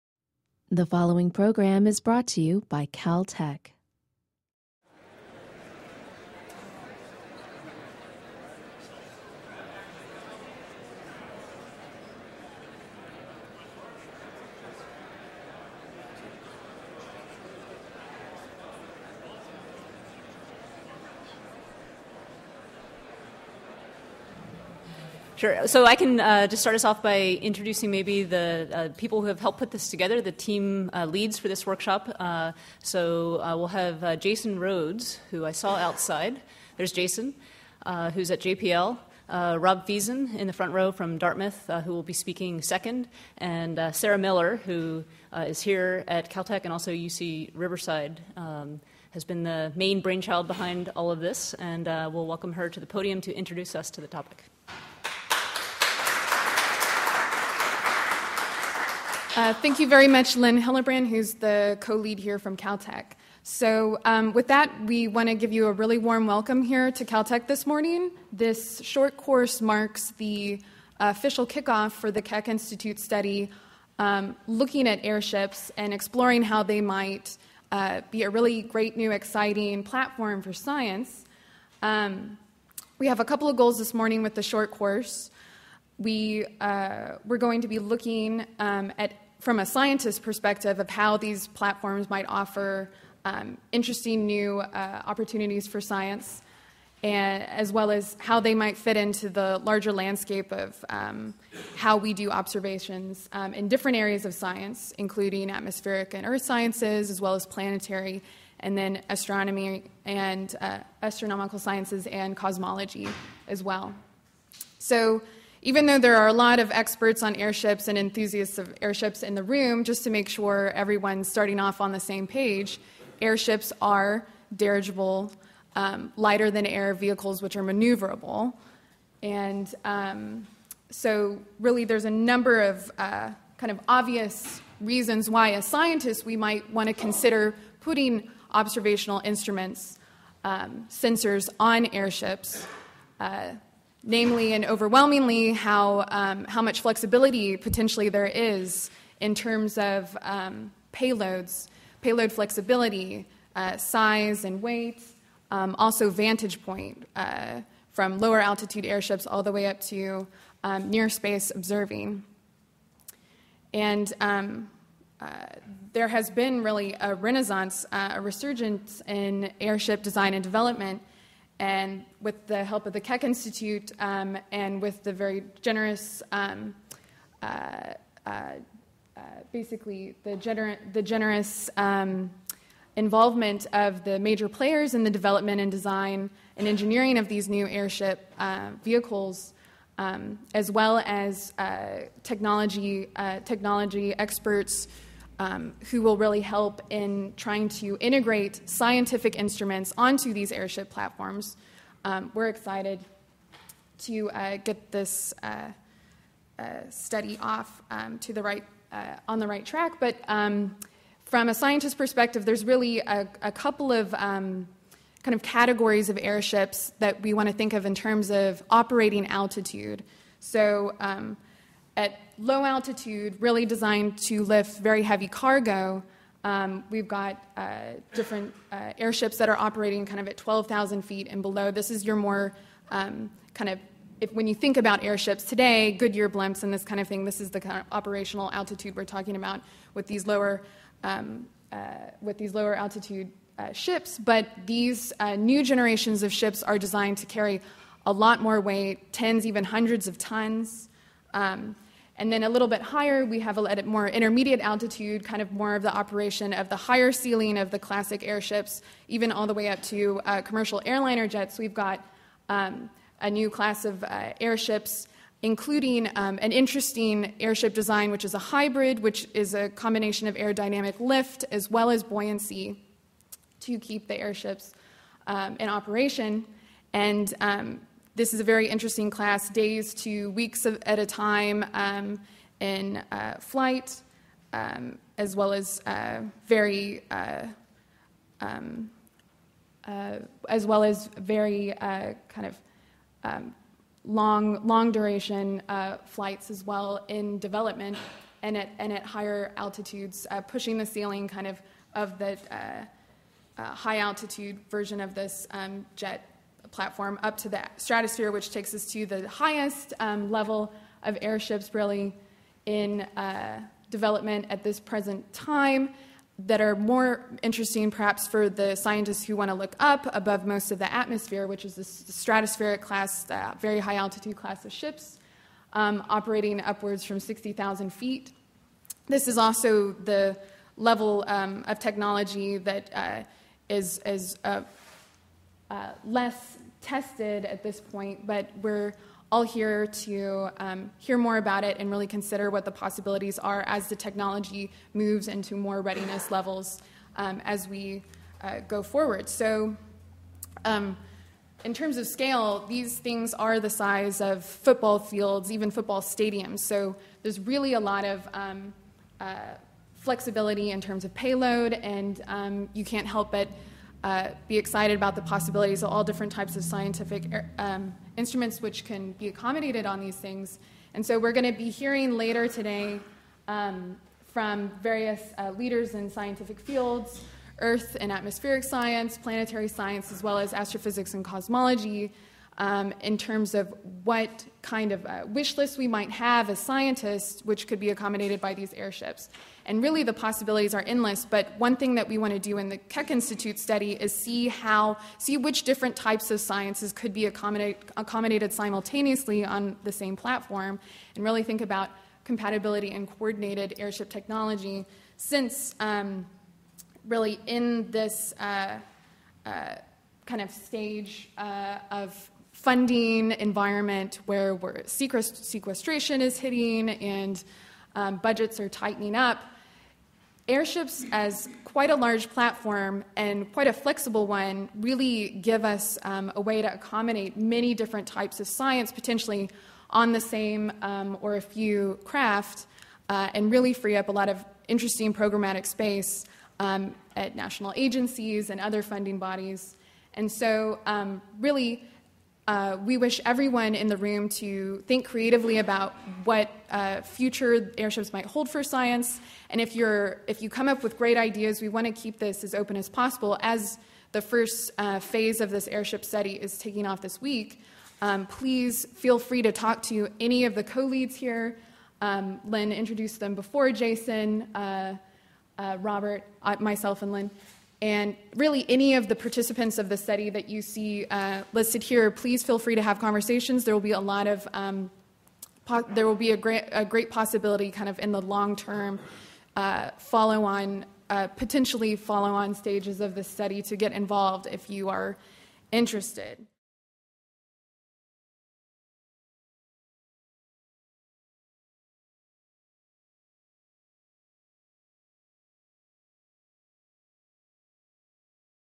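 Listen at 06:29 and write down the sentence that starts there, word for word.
And really, the possibilities are endless.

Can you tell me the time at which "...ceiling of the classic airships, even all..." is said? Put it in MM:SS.
04:17.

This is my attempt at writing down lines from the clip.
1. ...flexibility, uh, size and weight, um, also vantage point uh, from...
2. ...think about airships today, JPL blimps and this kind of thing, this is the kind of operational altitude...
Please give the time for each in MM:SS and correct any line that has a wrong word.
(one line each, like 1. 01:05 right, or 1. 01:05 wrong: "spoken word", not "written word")
1. 02:32 right
2. 03:54 wrong: "Goodyear", not "JPL".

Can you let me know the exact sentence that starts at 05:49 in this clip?
So, um, in terms of scale, these things are the size of football fields, even football stadiums.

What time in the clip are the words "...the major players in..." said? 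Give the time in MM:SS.
03:04.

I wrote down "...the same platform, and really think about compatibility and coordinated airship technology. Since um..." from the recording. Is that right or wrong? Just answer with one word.
right.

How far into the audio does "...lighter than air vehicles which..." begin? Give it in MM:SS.
02:06.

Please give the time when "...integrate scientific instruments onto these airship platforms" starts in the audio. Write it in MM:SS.
03:17.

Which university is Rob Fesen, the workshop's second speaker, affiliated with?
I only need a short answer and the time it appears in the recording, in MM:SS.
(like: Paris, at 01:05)
Dartmouth, at 00:41.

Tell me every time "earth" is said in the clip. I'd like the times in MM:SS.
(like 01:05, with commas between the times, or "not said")
01:46, 06:17.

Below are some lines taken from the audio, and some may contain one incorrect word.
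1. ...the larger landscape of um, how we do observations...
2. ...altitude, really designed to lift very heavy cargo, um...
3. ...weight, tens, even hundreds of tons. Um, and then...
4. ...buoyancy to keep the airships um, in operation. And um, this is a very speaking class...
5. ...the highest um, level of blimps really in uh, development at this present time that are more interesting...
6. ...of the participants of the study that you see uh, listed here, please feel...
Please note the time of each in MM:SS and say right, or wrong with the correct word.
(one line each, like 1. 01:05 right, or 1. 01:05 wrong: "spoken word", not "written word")
1. 01:39 right
2. 03:42 right
3. 04:08 right
4. 04:32 wrong: "interesting", not "speaking"
5. 05:09 wrong: "airships", not "blimps"
6. 07:48 right.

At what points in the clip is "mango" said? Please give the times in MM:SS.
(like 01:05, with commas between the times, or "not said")
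not said.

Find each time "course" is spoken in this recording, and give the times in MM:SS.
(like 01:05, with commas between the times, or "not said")
01:09, 01:24.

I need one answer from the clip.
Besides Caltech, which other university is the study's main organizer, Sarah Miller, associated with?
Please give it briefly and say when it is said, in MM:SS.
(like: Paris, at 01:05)
UC Riverside, at 00:46.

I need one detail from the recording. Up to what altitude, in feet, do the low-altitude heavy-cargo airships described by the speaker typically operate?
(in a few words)
12,000 feet.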